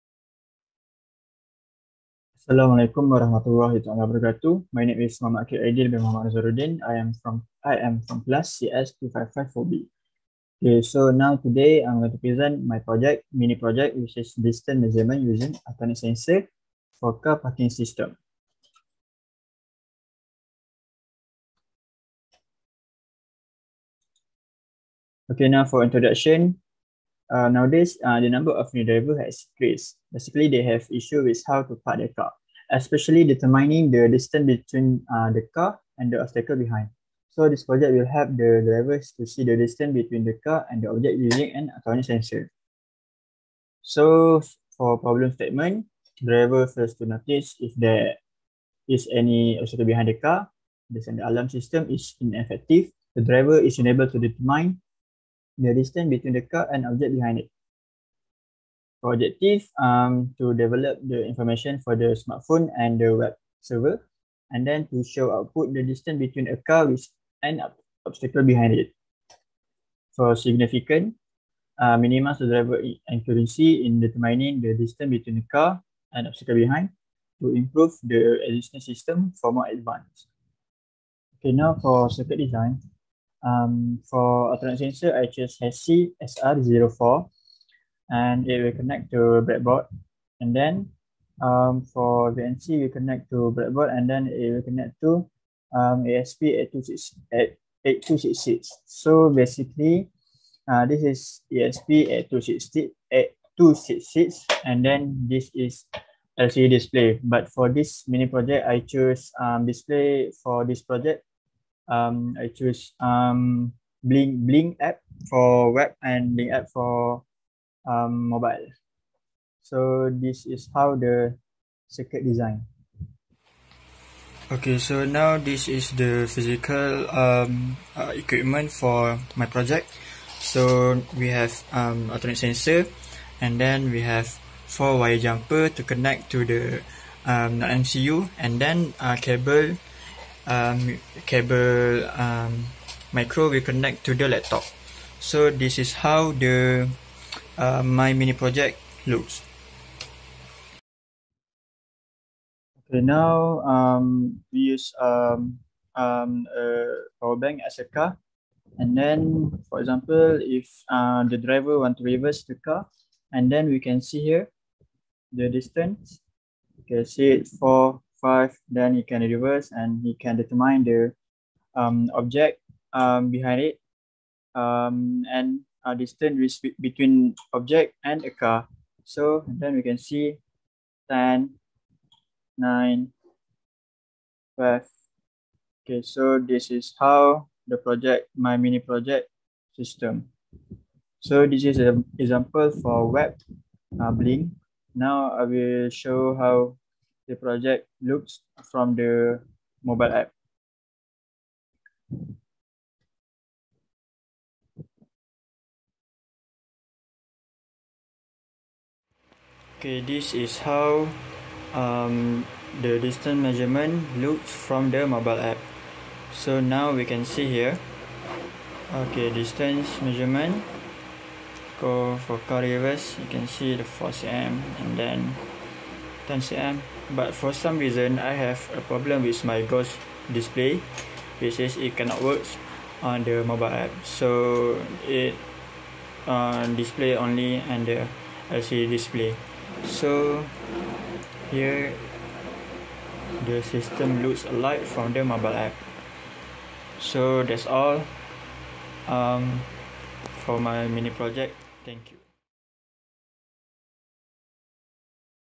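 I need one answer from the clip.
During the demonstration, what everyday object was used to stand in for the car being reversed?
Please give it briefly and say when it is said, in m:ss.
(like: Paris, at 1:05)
A power bank, at 2:37.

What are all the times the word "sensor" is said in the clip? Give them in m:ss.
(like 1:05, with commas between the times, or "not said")
0:16, 0:42, 1:24, 2:12.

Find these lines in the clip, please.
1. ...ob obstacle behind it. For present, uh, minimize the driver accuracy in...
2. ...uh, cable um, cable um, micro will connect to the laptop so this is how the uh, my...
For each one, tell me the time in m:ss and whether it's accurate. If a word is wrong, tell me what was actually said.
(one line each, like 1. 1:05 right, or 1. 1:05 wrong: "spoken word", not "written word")
1. 1:07 wrong: "significant", not "present"
2. 2:18 right.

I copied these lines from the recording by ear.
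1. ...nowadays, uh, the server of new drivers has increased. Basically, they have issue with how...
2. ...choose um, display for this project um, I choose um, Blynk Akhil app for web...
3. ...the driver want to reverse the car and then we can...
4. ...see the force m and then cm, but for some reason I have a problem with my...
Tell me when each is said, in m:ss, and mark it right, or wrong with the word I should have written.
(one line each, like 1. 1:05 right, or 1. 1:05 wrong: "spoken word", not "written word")
1. 0:27 wrong: "number", not "server"
2. 1:48 wrong: "Blynk", not "Akhil"
3. 2:41 right
4. 3:43 right.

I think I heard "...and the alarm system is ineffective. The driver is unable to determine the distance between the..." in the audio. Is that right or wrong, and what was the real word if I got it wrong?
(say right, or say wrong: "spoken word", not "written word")
right.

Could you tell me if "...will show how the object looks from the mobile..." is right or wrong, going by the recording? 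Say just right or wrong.
wrong.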